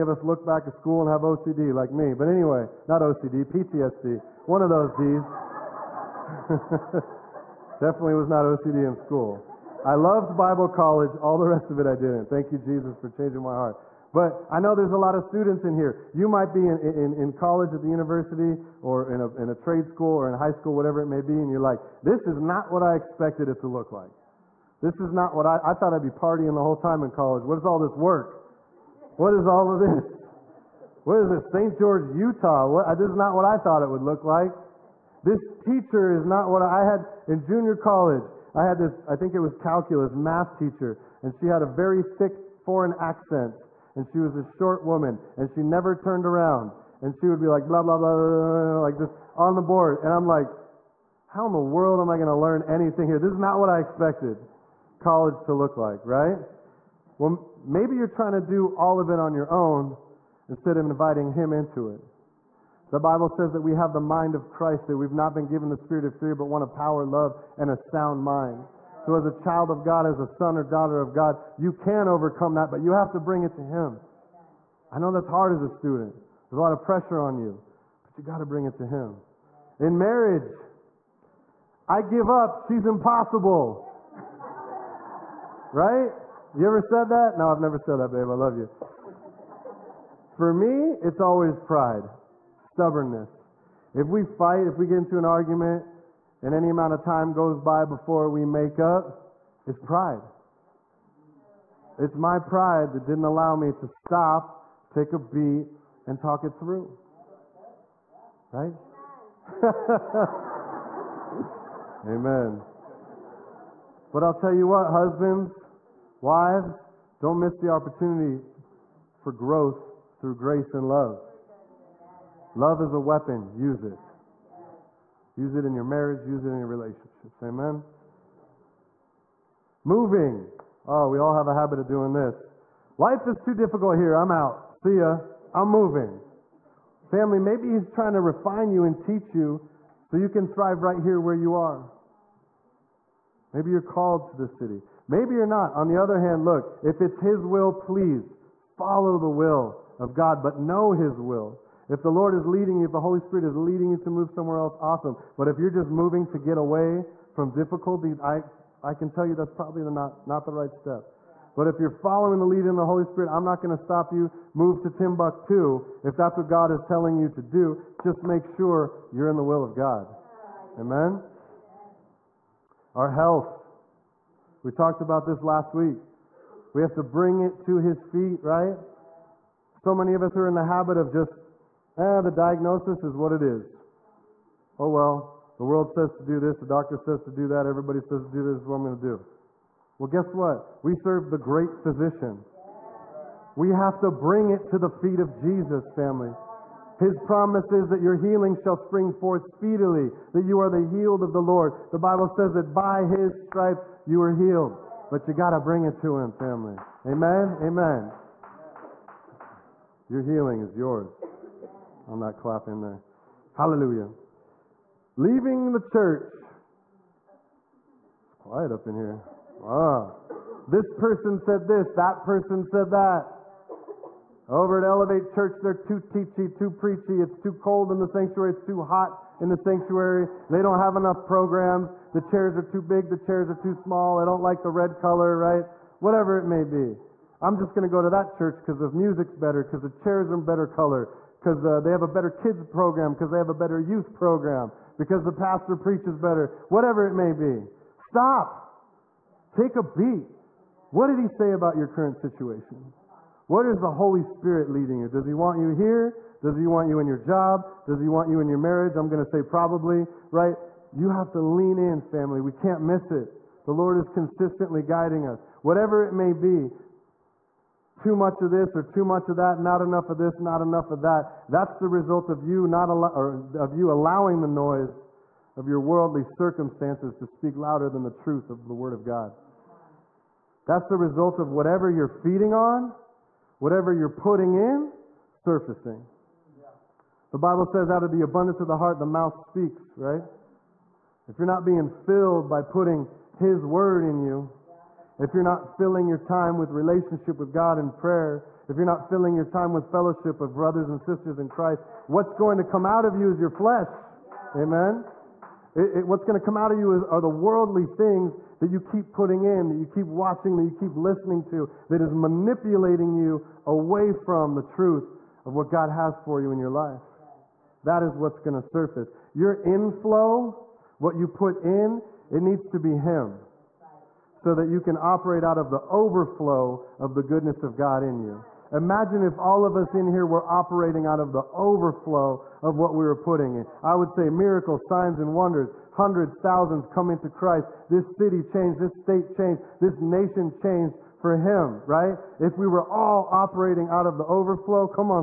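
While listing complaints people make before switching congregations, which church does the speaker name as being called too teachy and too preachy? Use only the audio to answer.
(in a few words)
Elevate Church.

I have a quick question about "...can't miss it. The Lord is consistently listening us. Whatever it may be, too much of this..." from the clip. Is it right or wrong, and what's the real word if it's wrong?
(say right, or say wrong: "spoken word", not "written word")
wrong: "guiding", not "listening".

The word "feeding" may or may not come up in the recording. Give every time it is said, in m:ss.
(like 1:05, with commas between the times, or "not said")
4:42.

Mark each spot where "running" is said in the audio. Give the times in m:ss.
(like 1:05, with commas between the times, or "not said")
not said.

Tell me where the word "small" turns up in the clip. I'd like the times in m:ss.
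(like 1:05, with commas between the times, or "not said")
3:53.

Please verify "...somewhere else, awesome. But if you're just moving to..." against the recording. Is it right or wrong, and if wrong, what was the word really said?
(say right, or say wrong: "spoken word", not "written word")
right.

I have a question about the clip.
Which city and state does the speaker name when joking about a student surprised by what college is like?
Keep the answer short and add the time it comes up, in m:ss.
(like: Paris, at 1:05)
St. George, Utah, at 0:31.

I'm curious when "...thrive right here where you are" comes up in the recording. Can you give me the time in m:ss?
2:20.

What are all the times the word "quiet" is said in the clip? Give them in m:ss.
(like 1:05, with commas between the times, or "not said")
3:38.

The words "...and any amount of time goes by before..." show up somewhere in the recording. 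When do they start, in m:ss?
1:36.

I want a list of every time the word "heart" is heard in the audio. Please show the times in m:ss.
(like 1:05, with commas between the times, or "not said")
0:13, 4:48.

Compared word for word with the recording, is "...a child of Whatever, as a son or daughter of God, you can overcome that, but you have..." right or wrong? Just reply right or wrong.
wrong.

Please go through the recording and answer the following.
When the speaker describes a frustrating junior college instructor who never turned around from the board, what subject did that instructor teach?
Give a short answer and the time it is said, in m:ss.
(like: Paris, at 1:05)
calculus, at 0:39.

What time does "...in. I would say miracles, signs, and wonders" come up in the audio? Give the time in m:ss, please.
5:33.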